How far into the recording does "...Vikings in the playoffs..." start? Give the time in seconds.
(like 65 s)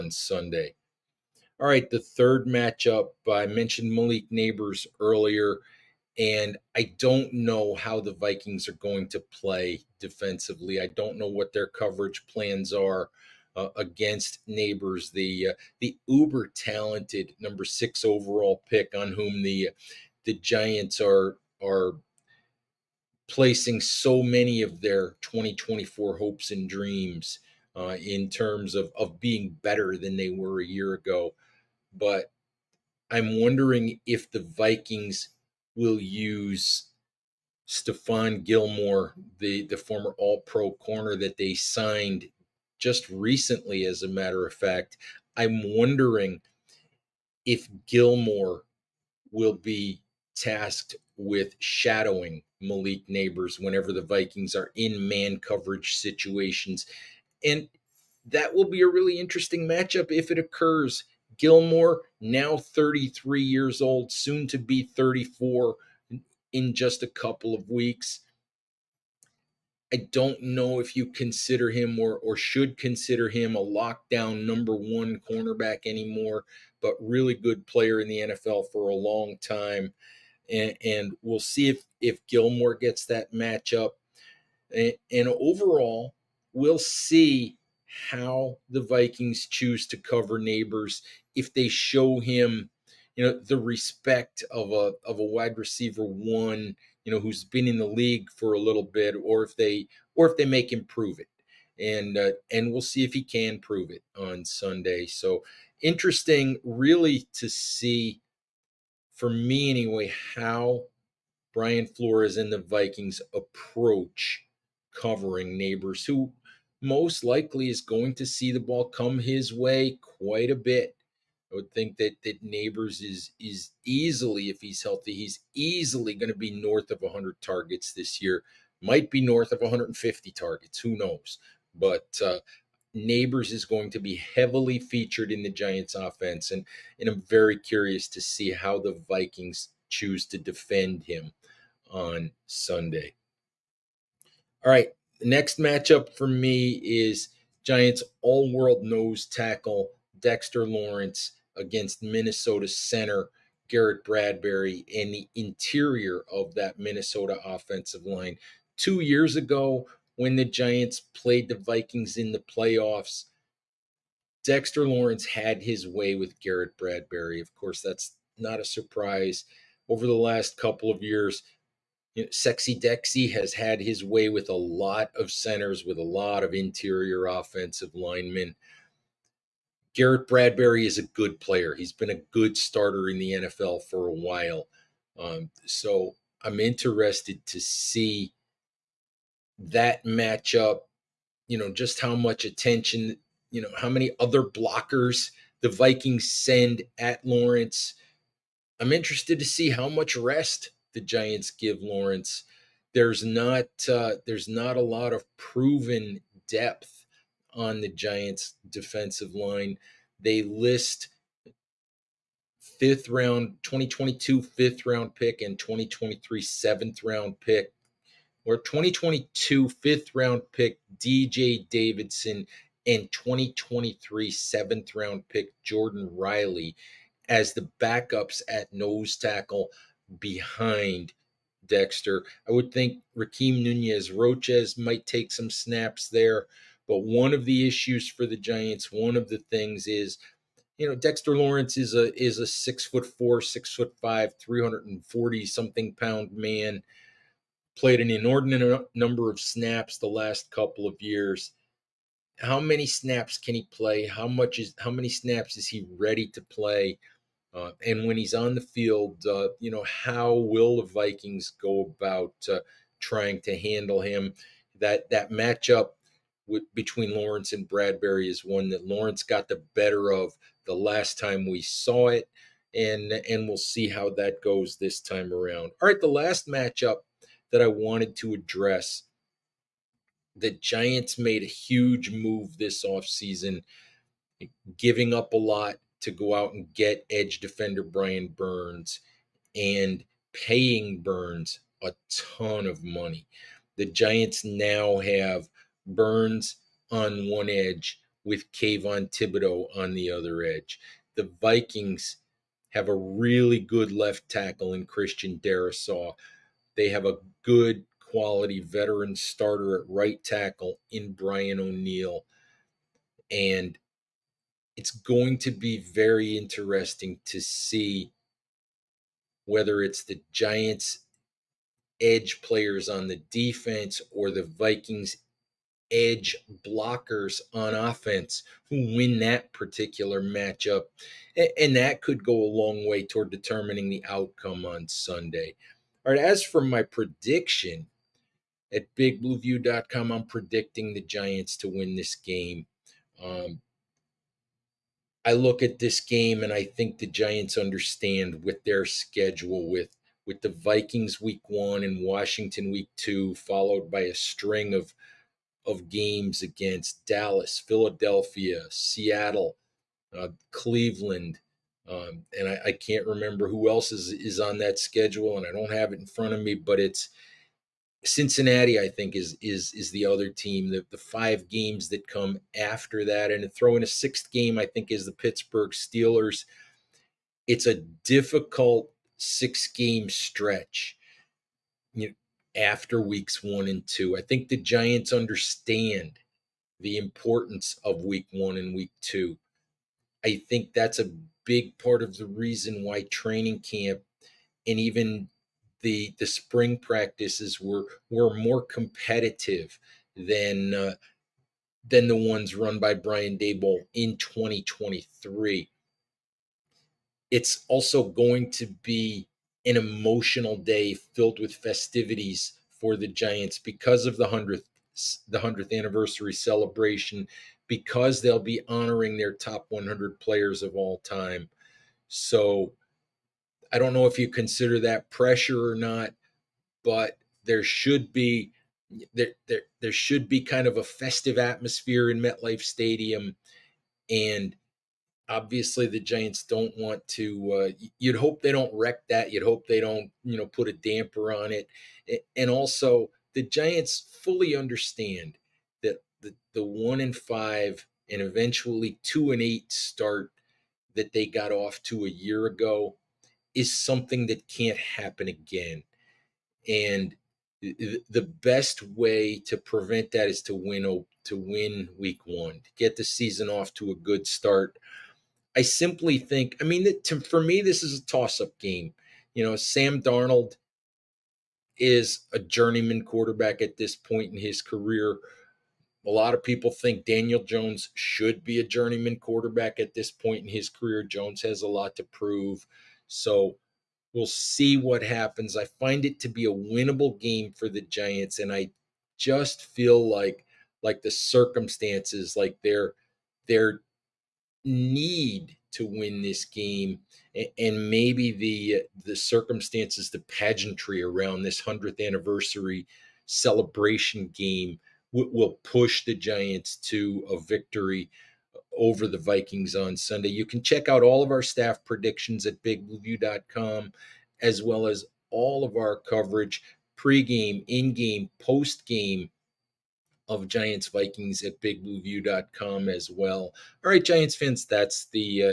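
161 s.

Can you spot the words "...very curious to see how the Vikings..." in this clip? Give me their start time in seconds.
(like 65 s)
137 s.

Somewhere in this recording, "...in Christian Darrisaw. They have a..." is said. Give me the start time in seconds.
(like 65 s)
304 s.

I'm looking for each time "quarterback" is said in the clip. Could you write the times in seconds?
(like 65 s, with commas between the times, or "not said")
473 s, 479 s.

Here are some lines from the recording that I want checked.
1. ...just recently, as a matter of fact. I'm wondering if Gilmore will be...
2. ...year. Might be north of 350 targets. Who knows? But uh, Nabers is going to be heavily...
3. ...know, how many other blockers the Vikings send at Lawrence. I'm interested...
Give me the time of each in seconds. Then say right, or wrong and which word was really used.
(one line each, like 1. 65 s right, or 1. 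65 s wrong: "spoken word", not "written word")
1. 42 s right
2. 128 s wrong: "150", not "350"
3. 193 s right.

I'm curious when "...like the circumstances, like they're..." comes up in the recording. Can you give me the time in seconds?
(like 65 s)
490 s.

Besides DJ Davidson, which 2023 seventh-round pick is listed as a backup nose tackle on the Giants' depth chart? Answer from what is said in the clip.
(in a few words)
Jordan Riley.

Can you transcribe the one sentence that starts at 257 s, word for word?
Uh, and when he's on the field, uh, you know, how will the Vikings go about uh, trying to handle him?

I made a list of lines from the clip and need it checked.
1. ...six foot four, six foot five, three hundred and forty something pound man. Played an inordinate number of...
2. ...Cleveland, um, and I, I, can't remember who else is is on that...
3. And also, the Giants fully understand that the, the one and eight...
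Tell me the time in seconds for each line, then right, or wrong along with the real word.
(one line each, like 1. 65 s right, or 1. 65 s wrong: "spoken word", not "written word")
1. 242 s right
2. 360 s right
3. 442 s wrong: "five", not "eight".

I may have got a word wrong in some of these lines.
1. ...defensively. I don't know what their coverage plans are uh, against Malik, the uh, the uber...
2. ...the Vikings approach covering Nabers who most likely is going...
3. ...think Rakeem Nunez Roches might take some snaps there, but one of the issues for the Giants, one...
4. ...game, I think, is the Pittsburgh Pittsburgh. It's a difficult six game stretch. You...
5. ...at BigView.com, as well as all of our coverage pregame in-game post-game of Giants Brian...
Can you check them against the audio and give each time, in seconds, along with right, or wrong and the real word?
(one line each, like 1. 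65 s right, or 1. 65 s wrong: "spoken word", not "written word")
1. 9 s wrong: "Nabers", not "Malik"
2. 112 s right
3. 232 s right
4. 374 s wrong: "Steelers", not "Pittsburgh"
5. 512 s wrong: "Vikings", not "Brian".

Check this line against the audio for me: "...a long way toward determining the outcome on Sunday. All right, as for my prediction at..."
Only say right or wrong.
right.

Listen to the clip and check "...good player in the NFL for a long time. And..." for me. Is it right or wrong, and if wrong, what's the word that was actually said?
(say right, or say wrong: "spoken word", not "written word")
right.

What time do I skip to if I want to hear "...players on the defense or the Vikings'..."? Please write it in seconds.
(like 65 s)
322 s.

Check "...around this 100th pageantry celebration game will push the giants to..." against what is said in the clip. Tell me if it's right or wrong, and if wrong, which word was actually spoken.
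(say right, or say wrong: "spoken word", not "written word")
wrong: "anniversary", not "pageantry".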